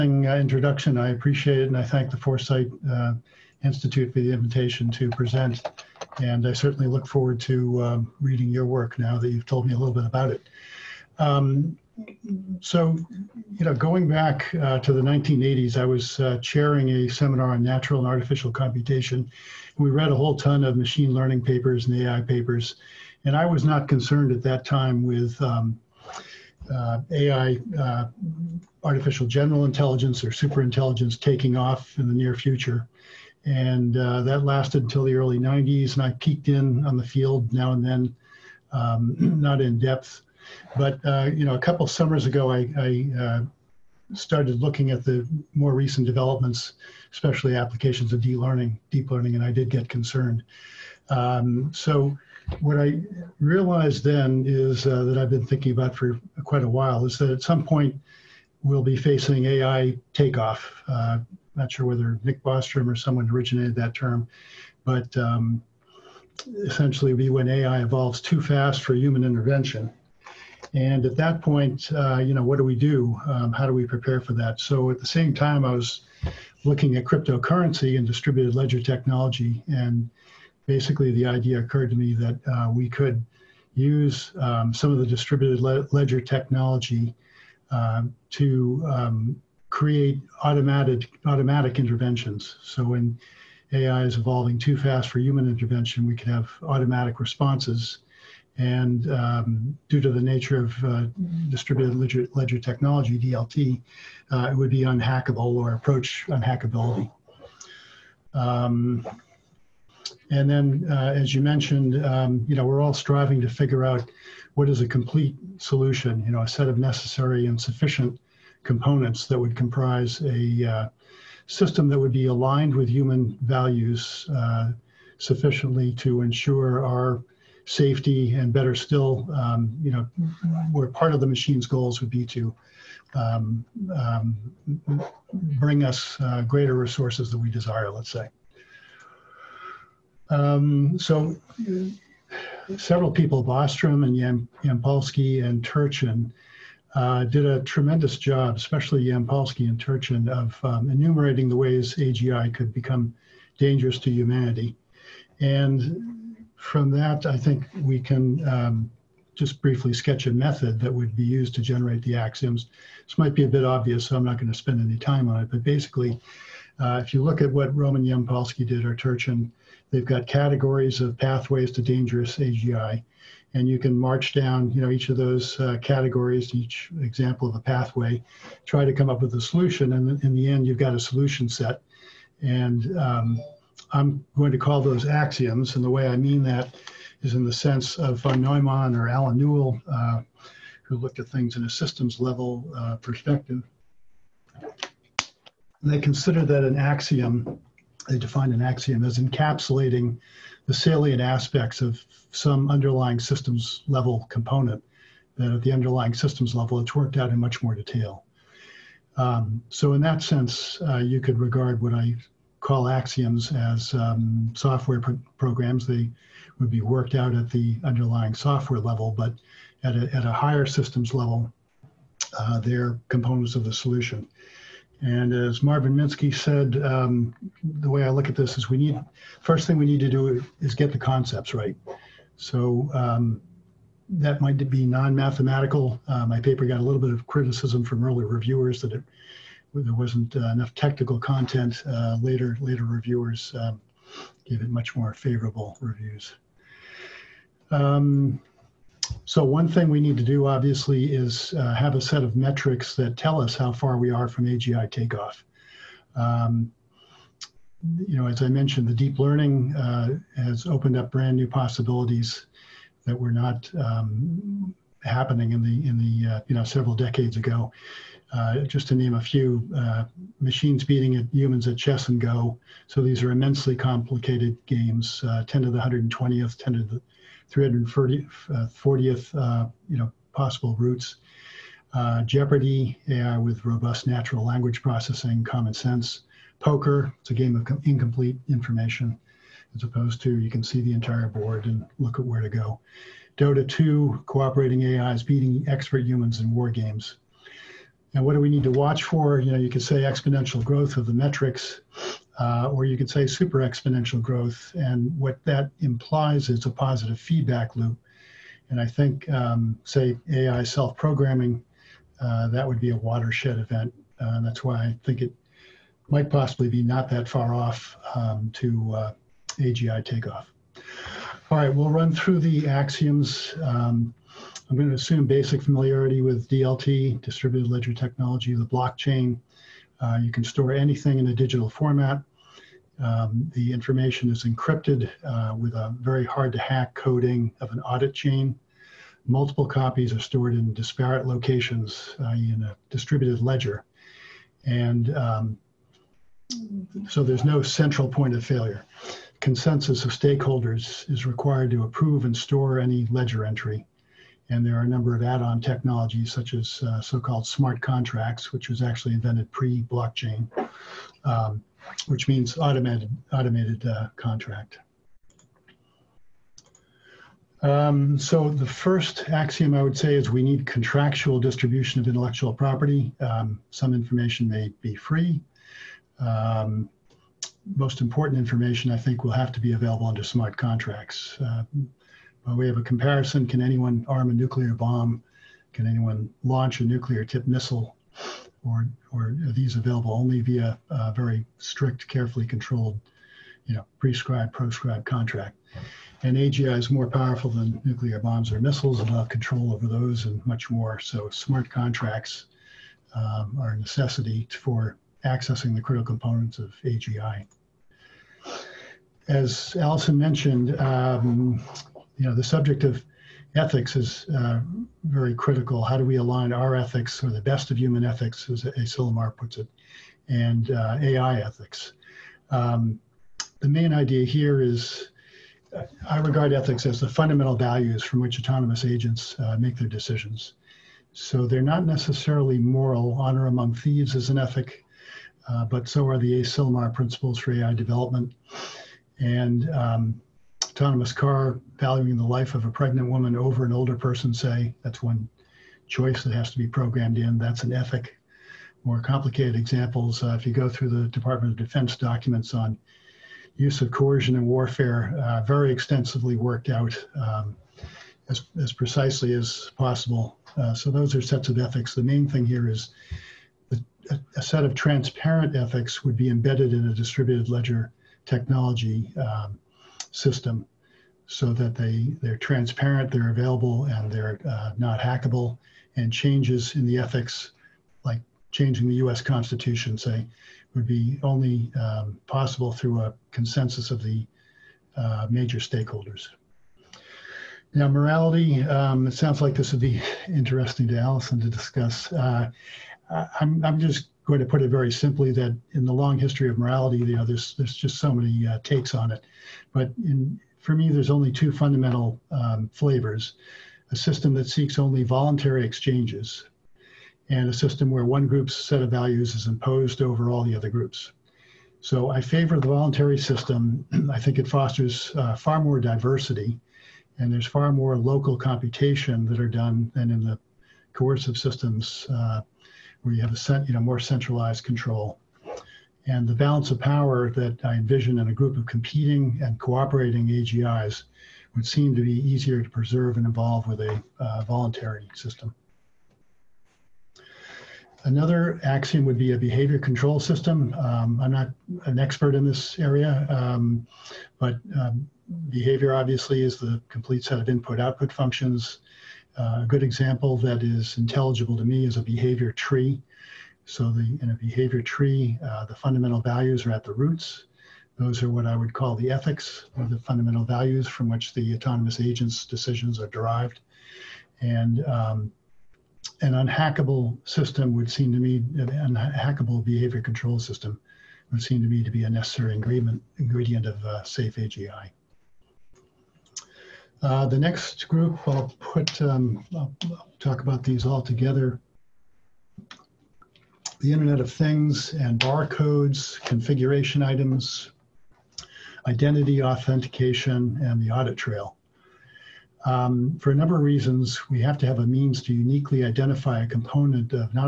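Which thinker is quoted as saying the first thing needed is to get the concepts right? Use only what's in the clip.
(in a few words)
Marvin Minsky.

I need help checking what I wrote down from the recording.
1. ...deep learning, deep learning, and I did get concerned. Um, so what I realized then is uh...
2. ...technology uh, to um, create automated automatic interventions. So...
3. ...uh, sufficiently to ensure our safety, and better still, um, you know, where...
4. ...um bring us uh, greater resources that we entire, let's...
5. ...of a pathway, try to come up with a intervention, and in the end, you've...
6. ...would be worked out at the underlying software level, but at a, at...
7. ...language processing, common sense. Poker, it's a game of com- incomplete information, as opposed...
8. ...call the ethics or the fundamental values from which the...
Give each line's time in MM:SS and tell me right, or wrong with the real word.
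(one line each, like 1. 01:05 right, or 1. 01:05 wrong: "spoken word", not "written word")
1. 00:48 right
2. 01:26 right
3. 02:04 right
4. 02:13 wrong: "desire", not "entire"
5. 02:57 wrong: "solution", not "intervention"
6. 03:36 right
7. 04:44 right
8. 09:18 right.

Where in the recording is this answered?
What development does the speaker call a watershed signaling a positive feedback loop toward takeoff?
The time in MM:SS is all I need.
05:10.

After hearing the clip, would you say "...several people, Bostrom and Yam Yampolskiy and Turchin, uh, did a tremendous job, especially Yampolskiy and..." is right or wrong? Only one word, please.
right.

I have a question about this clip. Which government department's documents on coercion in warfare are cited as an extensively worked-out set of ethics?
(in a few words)
Department of Defense.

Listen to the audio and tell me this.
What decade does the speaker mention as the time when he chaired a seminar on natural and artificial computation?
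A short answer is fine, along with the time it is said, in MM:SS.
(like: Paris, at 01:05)
1980s, at 00:15.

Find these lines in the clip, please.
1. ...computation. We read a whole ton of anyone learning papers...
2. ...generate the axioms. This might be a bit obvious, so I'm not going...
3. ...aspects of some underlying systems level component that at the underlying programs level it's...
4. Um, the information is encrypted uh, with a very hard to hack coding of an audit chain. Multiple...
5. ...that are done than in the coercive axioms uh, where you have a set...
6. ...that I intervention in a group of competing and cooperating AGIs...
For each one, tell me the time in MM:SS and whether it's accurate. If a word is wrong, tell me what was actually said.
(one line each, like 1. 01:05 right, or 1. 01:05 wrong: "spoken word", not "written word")
1. 00:18 wrong: "machine", not "anyone"
2. 02:41 right
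3. 03:21 wrong: "systems", not "programs"
4. 05:32 right
5. 08:39 wrong: "systems", not "axioms"
6. 08:47 wrong: "envision", not "intervention".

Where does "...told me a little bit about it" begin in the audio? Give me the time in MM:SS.
00:09.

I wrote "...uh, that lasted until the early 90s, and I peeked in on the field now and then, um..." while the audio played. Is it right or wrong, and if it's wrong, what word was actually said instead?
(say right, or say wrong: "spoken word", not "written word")
right.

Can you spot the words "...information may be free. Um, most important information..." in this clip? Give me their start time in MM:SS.
06:13.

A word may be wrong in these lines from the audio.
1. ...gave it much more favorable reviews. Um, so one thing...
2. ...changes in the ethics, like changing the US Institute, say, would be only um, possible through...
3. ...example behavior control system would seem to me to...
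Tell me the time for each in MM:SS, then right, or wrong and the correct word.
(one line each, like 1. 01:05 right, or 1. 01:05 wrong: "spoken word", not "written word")
1. 04:04 right
2. 07:56 wrong: "Constitution", not "Institute"
3. 09:28 wrong: "unhackable", not "example".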